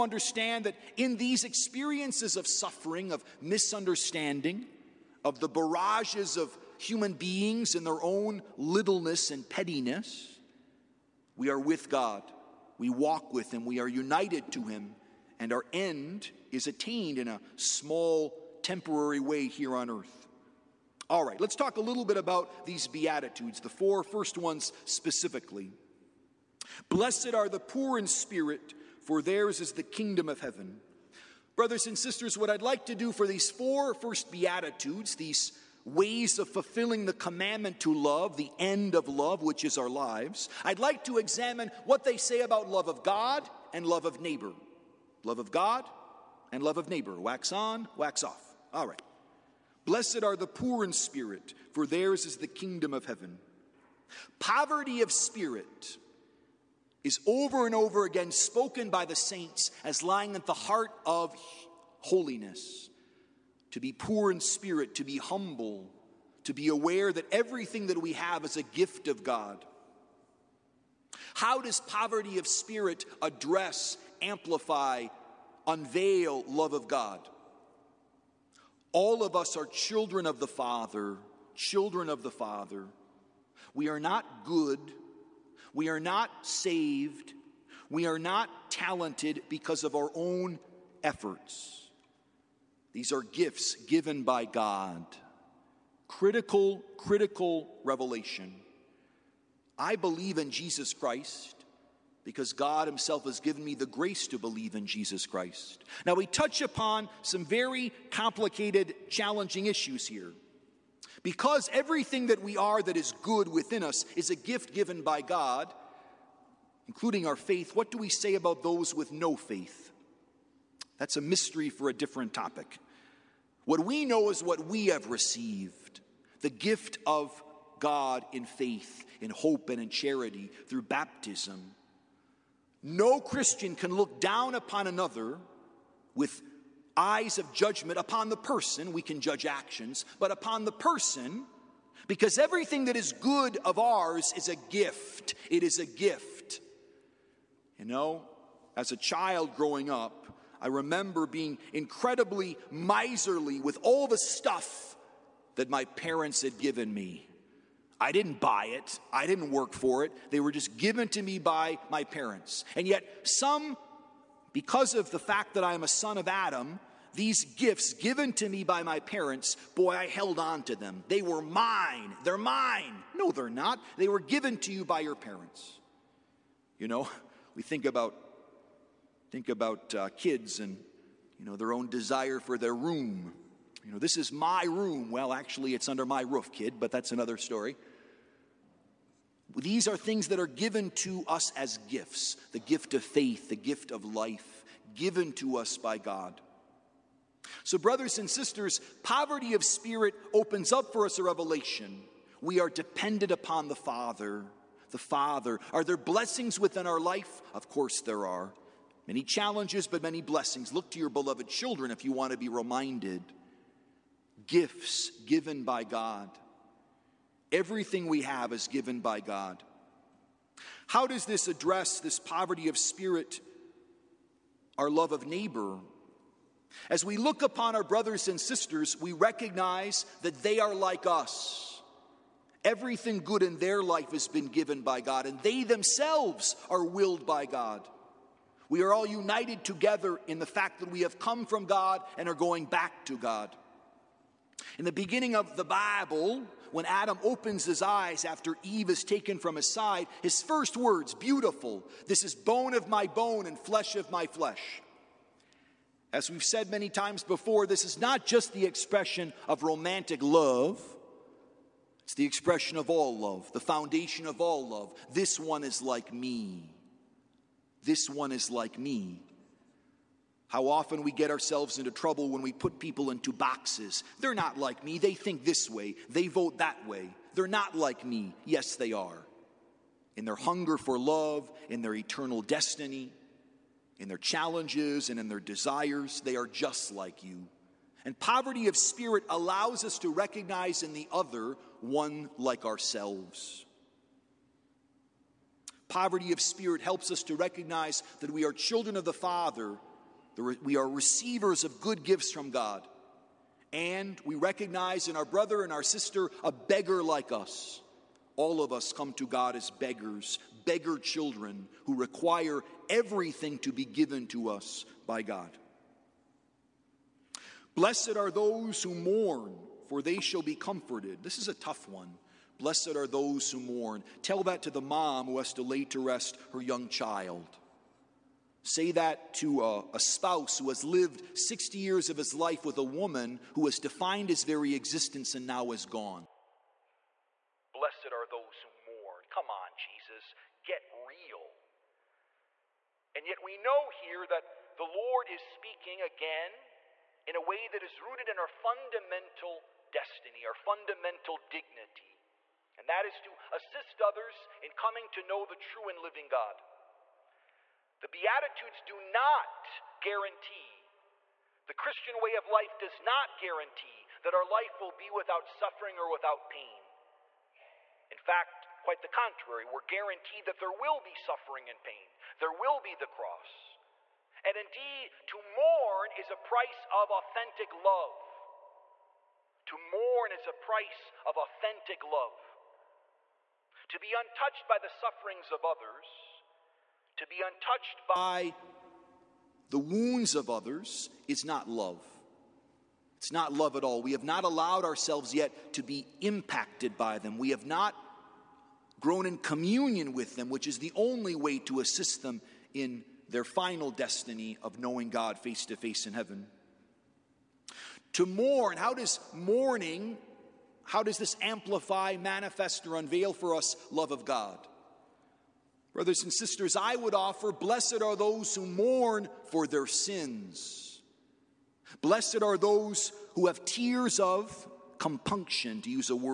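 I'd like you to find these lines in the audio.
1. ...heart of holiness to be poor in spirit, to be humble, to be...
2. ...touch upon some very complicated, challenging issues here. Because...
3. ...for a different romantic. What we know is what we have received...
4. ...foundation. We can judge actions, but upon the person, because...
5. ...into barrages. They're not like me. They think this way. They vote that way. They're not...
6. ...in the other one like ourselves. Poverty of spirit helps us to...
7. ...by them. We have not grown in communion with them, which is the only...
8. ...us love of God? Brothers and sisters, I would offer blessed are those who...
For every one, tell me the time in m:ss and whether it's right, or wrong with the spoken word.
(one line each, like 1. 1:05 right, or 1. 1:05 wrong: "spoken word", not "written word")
1. 1:00 right
2. 1:46 right
3. 2:01 wrong: "topic", not "romantic"
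4. 2:18 wrong: "person", not "foundation"
5. 4:33 wrong: "boxes", not "barrages"
6. 4:50 right
7. 6:36 right
8. 6:53 right.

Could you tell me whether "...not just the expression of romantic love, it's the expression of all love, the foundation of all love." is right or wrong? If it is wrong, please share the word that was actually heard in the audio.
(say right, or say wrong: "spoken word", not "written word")
right.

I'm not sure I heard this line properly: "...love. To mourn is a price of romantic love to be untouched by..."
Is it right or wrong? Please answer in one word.
wrong.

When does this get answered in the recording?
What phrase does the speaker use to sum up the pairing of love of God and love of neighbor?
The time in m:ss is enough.
0:47.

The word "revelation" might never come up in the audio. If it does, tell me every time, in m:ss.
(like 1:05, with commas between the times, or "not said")
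1:37, 3:21.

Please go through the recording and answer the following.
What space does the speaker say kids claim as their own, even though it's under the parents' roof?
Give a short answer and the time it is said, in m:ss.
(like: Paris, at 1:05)
Their room, at 3:04.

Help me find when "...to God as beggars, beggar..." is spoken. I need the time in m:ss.
5:09.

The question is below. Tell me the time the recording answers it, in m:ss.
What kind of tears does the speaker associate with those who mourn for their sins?
7:03.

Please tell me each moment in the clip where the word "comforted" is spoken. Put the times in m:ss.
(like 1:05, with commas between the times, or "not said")
5:20.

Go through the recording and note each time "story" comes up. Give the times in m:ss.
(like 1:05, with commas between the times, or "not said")
3:07.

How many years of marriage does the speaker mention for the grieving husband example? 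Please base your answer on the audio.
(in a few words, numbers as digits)
60.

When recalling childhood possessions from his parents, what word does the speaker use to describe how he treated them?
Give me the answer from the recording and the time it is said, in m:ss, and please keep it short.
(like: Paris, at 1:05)
Miserly, at 2:32.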